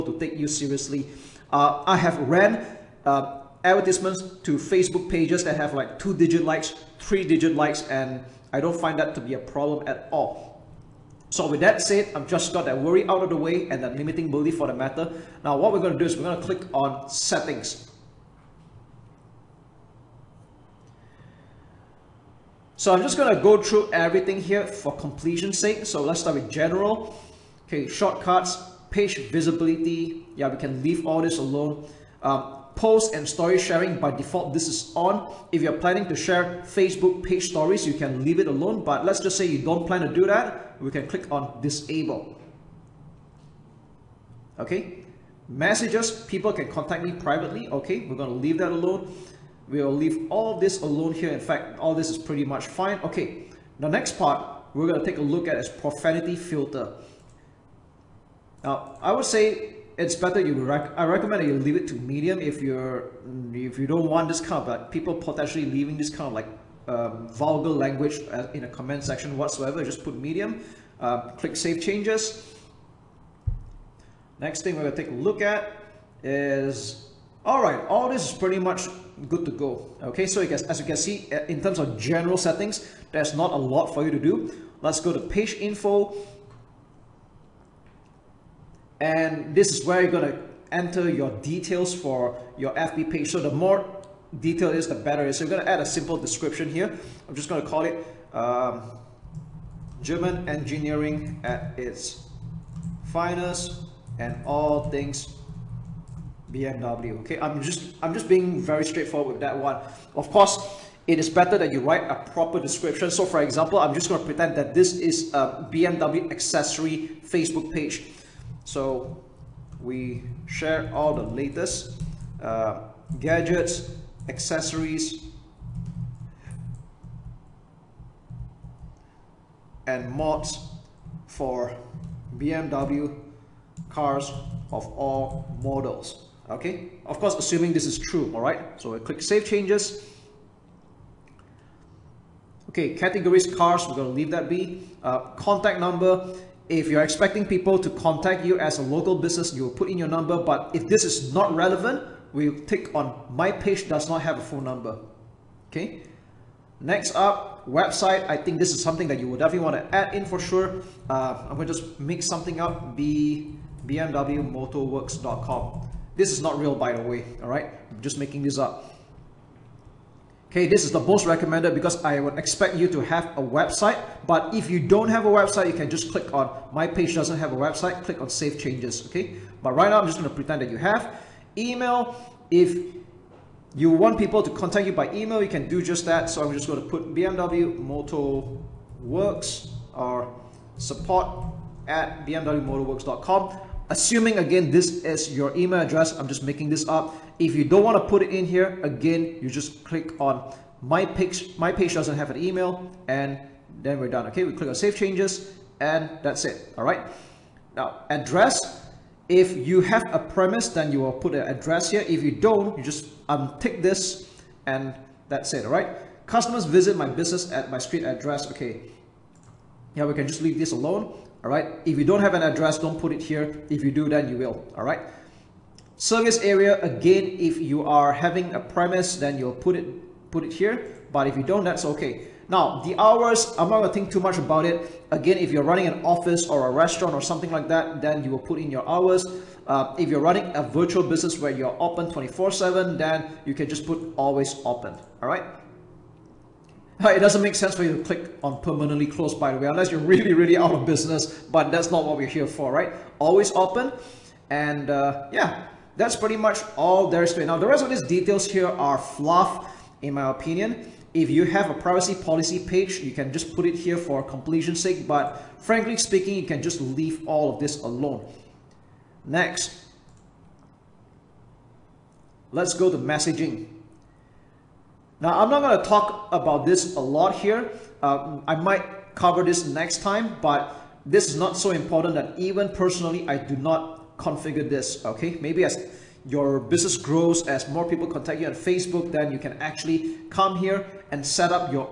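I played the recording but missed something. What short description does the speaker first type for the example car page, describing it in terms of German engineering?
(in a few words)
German engineering at its finest.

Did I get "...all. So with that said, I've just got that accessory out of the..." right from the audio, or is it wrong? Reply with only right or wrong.
wrong.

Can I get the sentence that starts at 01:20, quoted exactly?
Okay, so guess, as you can see, uh, in terms of general settings, there's not a lot for you to do.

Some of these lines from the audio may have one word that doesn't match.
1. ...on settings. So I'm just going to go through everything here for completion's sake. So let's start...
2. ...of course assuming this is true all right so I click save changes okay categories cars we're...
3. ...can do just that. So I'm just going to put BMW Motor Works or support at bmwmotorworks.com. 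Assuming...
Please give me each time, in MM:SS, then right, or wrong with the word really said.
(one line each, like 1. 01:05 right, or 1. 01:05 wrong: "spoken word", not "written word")
1. 00:16 right
2. 02:17 right
3. 03:05 right.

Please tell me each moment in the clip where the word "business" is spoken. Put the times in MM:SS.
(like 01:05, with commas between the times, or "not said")
02:29, 03:37, 04:01, 04:10, 04:46.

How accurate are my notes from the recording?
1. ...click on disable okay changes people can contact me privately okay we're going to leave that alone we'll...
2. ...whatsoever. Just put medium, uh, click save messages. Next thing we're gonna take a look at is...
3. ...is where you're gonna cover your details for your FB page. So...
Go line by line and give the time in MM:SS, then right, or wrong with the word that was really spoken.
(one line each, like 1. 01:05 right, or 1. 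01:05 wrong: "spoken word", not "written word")
1. 00:41 wrong: "messages", not "changes"
2. 01:09 wrong: "changes", not "messages"
3. 01:29 wrong: "enter", not "cover".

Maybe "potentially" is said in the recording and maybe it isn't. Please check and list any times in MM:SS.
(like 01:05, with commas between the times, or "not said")
01:05.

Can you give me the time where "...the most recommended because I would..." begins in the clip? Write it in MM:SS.
02:50.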